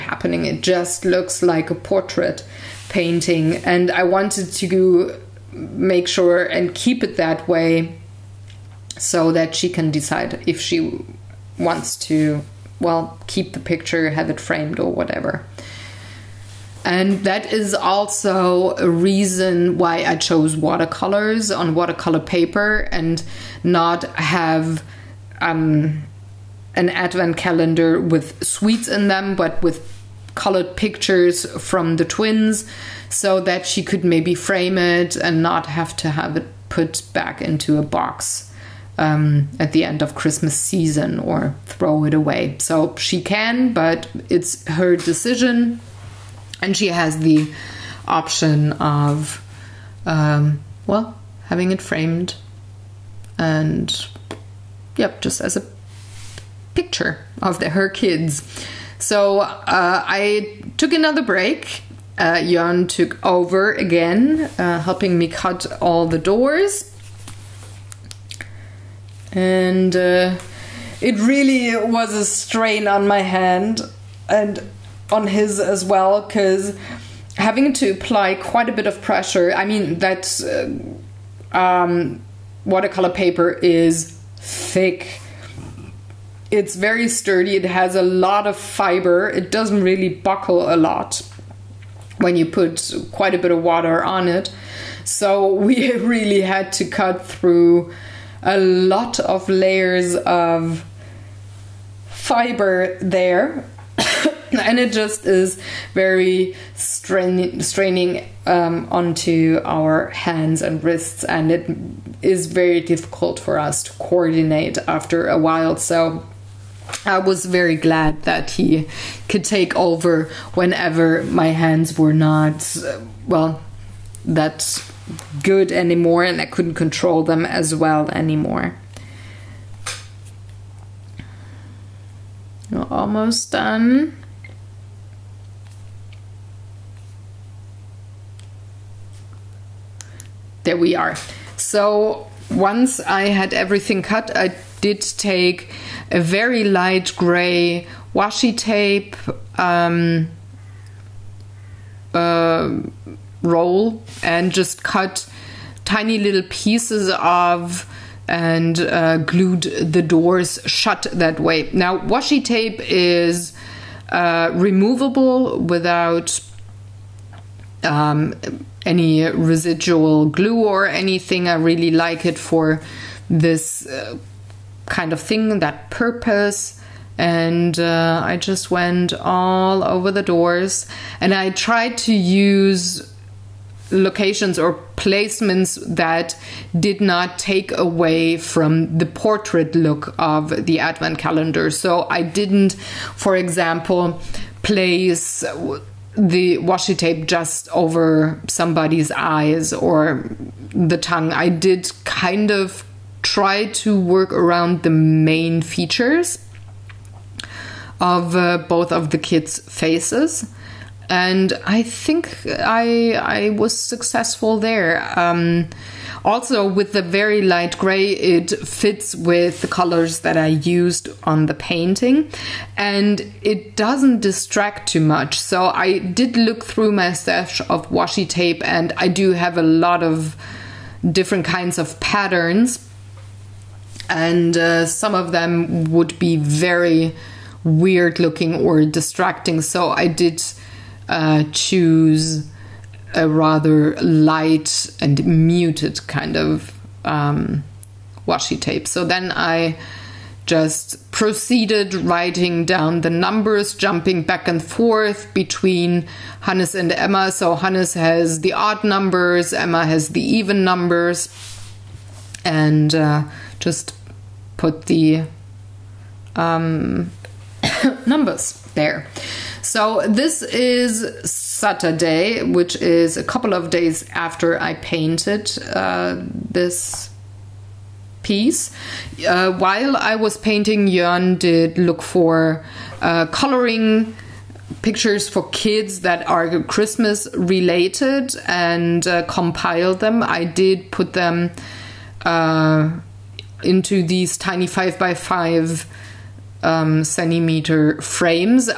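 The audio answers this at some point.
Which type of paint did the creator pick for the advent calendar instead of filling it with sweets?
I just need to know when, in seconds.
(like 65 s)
20 s.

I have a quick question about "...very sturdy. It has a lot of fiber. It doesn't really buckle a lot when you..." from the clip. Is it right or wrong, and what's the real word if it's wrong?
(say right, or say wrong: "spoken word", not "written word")
right.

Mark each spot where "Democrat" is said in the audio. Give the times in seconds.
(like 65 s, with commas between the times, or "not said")
not said.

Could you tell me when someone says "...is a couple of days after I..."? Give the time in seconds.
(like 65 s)
272 s.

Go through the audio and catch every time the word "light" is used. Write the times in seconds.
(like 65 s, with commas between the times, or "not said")
146 s, 217 s, 244 s.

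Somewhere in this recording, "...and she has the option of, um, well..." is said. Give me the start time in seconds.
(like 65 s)
46 s.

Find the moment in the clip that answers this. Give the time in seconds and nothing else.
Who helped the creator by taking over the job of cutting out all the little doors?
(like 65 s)
62 s.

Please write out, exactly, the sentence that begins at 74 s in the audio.
And on his as well because having to apply quite a bit of pressure.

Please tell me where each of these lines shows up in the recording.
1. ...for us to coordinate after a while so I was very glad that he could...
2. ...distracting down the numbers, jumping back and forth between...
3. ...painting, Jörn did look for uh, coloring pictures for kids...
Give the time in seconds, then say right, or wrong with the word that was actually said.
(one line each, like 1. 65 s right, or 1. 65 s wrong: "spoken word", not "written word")
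1. 113 s right
2. 251 s wrong: "writing", not "distracting"
3. 280 s right.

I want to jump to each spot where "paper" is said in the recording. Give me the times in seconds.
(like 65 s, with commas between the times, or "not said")
22 s, 83 s.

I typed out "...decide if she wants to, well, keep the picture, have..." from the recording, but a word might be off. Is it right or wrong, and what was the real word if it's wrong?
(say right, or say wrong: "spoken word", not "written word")
right.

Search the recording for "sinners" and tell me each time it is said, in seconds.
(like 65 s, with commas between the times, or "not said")
not said.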